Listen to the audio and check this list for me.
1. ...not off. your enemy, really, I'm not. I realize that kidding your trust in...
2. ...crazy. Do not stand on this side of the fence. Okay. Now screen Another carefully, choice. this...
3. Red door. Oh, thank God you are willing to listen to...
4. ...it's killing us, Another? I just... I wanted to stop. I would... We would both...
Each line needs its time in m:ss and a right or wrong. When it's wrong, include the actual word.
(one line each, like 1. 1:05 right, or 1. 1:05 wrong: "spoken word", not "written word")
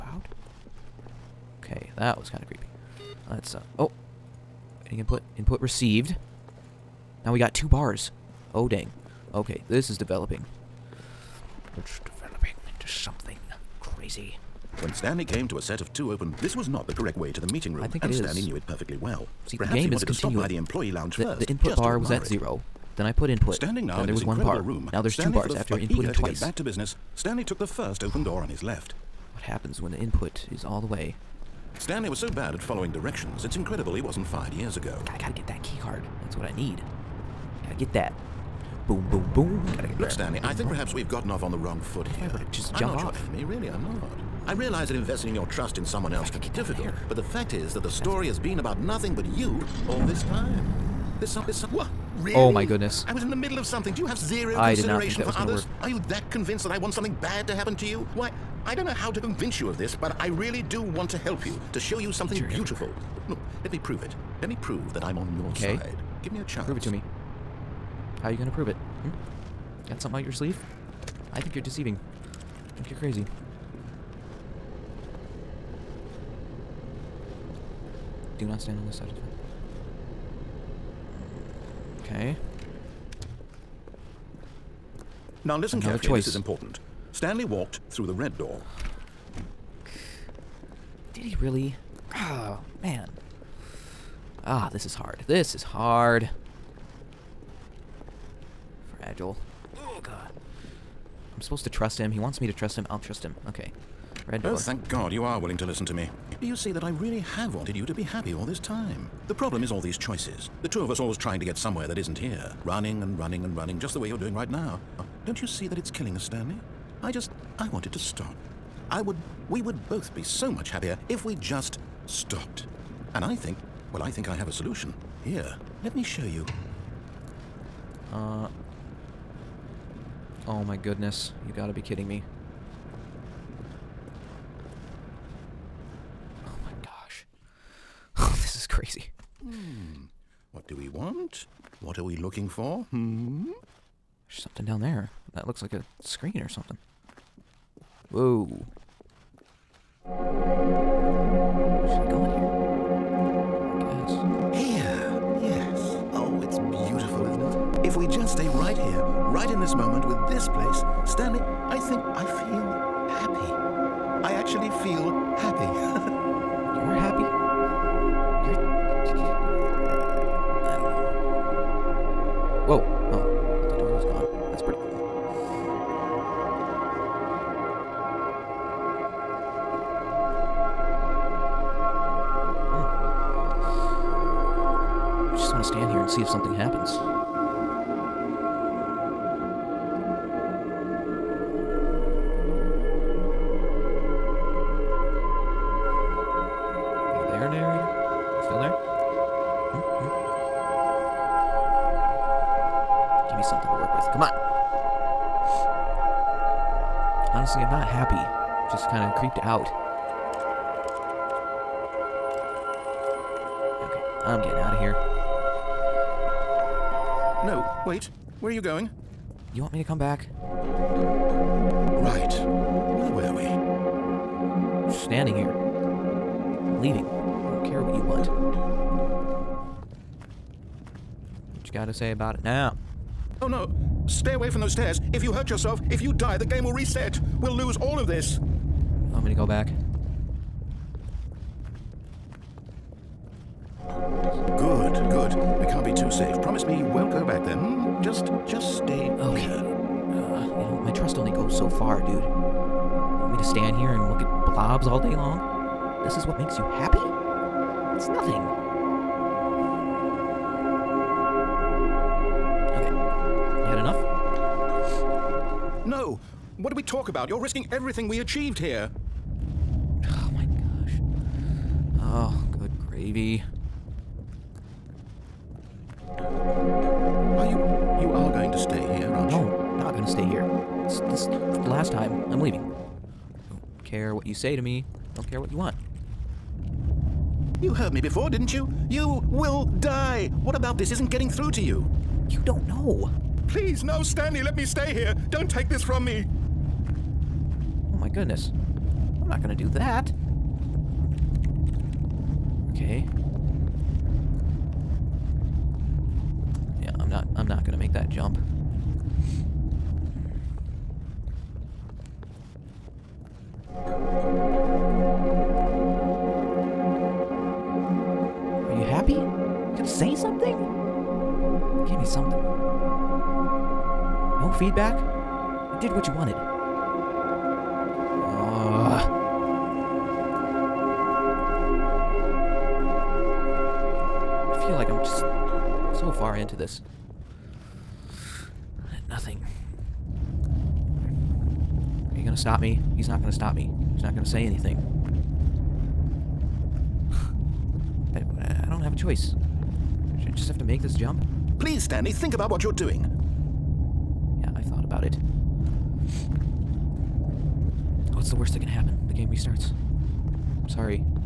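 1. 0:42 wrong: "investing", not "kidding"
2. 1:12 wrong: "listen", not "screen"
3. 1:44 right
4. 1:55 wrong: "Stanley", not "Another".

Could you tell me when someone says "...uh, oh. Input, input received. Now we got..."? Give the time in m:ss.
0:03.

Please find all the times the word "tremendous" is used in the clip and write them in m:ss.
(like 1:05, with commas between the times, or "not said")
not said.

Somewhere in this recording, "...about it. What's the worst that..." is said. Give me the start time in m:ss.
5:54.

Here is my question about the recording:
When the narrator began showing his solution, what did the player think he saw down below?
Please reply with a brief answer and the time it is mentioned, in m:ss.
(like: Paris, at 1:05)
a screen, at 2:25.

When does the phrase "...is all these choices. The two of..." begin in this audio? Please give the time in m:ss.
1:49.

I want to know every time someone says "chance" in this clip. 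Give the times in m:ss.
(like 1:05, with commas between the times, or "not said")
1:06.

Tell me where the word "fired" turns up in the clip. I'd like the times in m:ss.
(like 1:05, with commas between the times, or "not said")
0:34.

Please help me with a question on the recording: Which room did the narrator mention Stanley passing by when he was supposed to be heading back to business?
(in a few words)
employee lounge.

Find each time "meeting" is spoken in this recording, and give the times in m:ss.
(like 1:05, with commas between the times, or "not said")
0:17.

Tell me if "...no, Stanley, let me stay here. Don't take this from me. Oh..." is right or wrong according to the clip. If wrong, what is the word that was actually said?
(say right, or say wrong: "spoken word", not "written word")
right.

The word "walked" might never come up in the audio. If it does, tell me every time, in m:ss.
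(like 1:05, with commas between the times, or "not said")
1:27.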